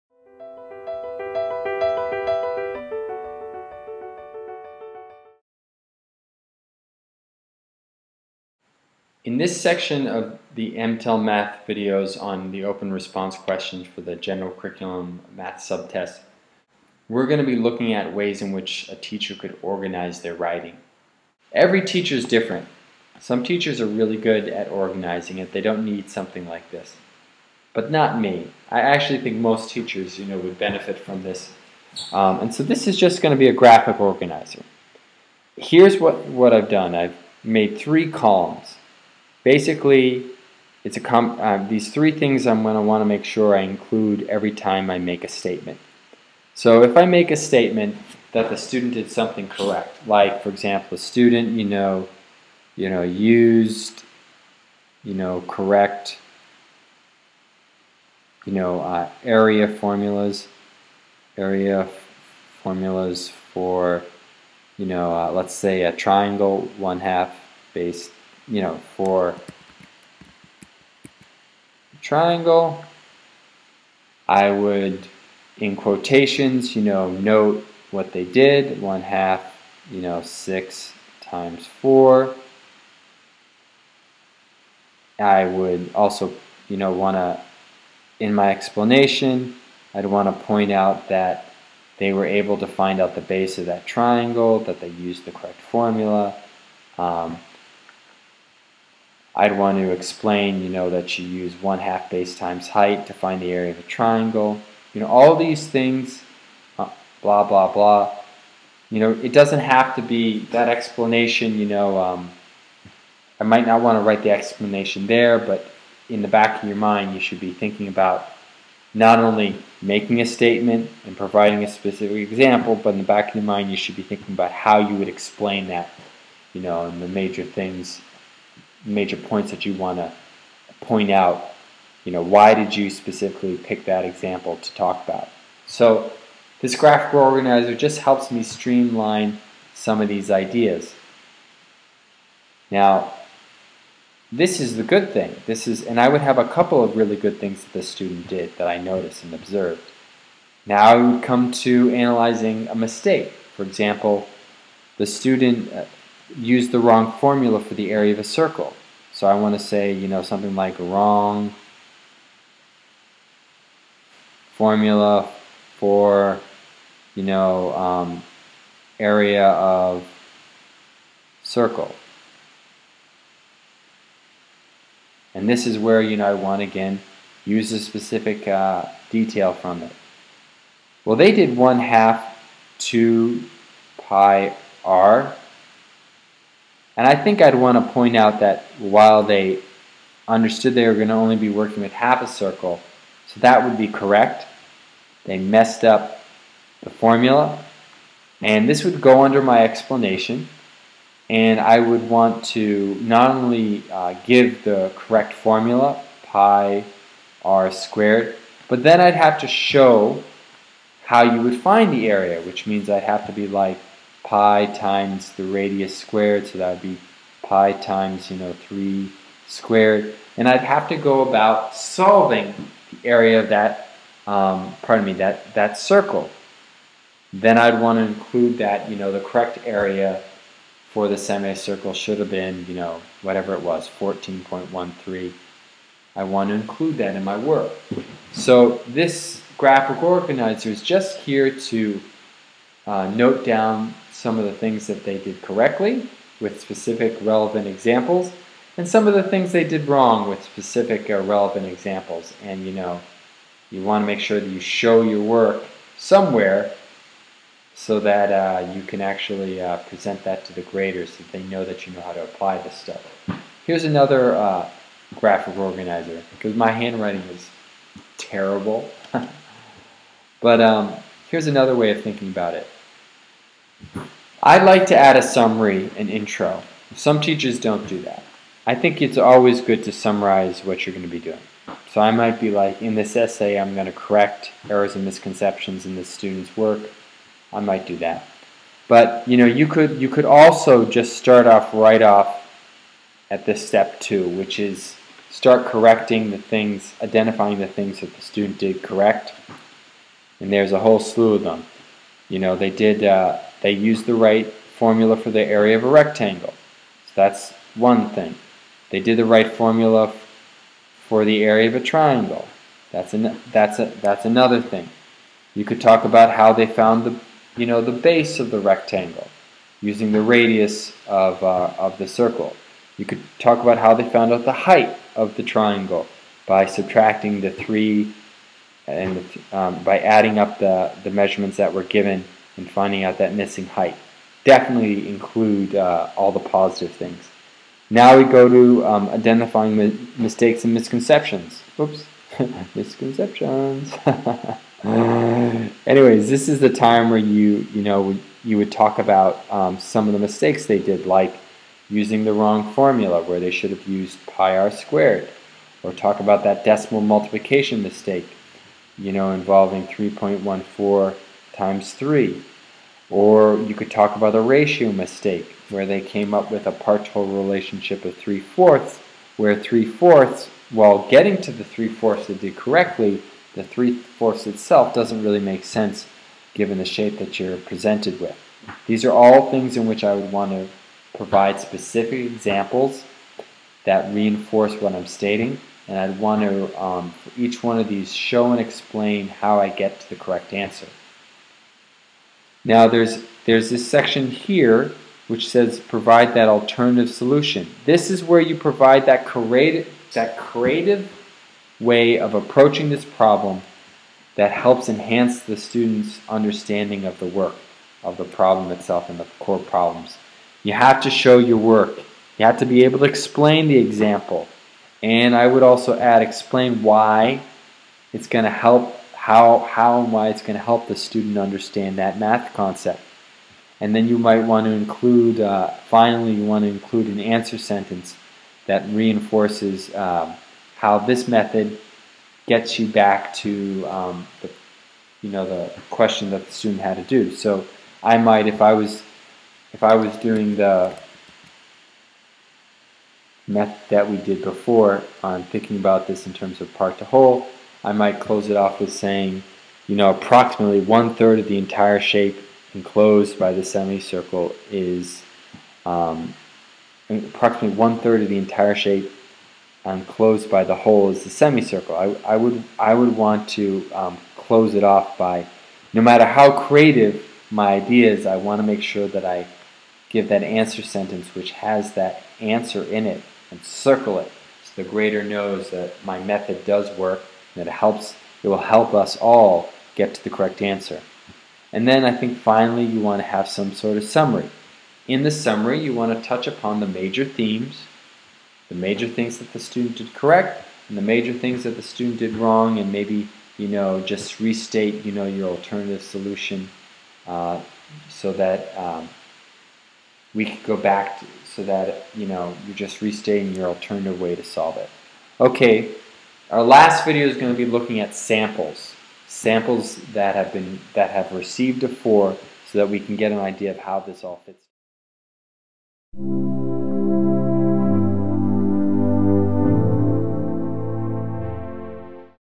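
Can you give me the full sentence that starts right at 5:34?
Definitely include uh, all the positive things.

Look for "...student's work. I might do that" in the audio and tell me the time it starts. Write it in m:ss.
4:46.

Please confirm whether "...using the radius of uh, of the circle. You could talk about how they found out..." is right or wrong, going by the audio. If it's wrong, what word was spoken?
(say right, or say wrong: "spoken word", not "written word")
right.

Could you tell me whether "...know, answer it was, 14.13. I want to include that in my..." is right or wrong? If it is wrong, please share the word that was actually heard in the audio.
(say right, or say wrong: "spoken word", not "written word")
wrong: "whatever", not "answer".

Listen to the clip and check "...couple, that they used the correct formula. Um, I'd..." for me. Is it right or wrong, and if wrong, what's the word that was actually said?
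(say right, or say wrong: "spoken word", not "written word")
wrong: "triangle", not "couple".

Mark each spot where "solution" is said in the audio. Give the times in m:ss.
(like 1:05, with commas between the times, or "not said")
6:37, 8:16.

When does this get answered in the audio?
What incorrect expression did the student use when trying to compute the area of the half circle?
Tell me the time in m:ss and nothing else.
3:01.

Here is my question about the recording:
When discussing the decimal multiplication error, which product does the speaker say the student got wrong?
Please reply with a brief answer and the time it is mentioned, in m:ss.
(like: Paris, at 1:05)
3.14 times 3, at 5:59.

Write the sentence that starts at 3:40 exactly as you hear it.
And I'd have to go about solving the area of that, um, pardon me, that, that circle.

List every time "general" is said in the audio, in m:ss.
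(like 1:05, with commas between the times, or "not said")
0:14.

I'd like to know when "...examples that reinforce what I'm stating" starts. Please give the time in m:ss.
6:22.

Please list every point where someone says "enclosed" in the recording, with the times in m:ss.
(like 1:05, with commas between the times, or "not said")
7:32, 7:39.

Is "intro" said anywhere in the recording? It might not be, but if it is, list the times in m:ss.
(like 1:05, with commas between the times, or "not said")
4:36.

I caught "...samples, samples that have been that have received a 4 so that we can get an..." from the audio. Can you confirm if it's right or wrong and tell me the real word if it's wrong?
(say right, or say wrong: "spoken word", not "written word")
right.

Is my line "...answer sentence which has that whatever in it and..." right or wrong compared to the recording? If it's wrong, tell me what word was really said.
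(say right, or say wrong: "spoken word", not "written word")
wrong: "answer", not "whatever".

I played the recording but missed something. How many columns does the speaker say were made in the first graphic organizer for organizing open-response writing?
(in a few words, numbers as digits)
3.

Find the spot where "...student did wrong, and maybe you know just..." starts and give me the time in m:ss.
8:11.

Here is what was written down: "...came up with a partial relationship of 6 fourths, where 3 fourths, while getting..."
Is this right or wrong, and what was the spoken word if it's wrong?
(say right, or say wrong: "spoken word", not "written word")
wrong: "3", not "6".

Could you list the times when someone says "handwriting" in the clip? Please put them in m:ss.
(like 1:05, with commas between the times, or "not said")
4:26.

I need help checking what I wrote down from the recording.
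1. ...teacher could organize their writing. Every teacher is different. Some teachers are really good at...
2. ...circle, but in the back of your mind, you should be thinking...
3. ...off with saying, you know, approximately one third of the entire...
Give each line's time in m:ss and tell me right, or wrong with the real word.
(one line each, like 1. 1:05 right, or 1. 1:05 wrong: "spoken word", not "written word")
1. 0:18 right
2. 2:02 wrong: "example", not "circle"
3. 7:28 right.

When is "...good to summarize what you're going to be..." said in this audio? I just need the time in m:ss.
4:39.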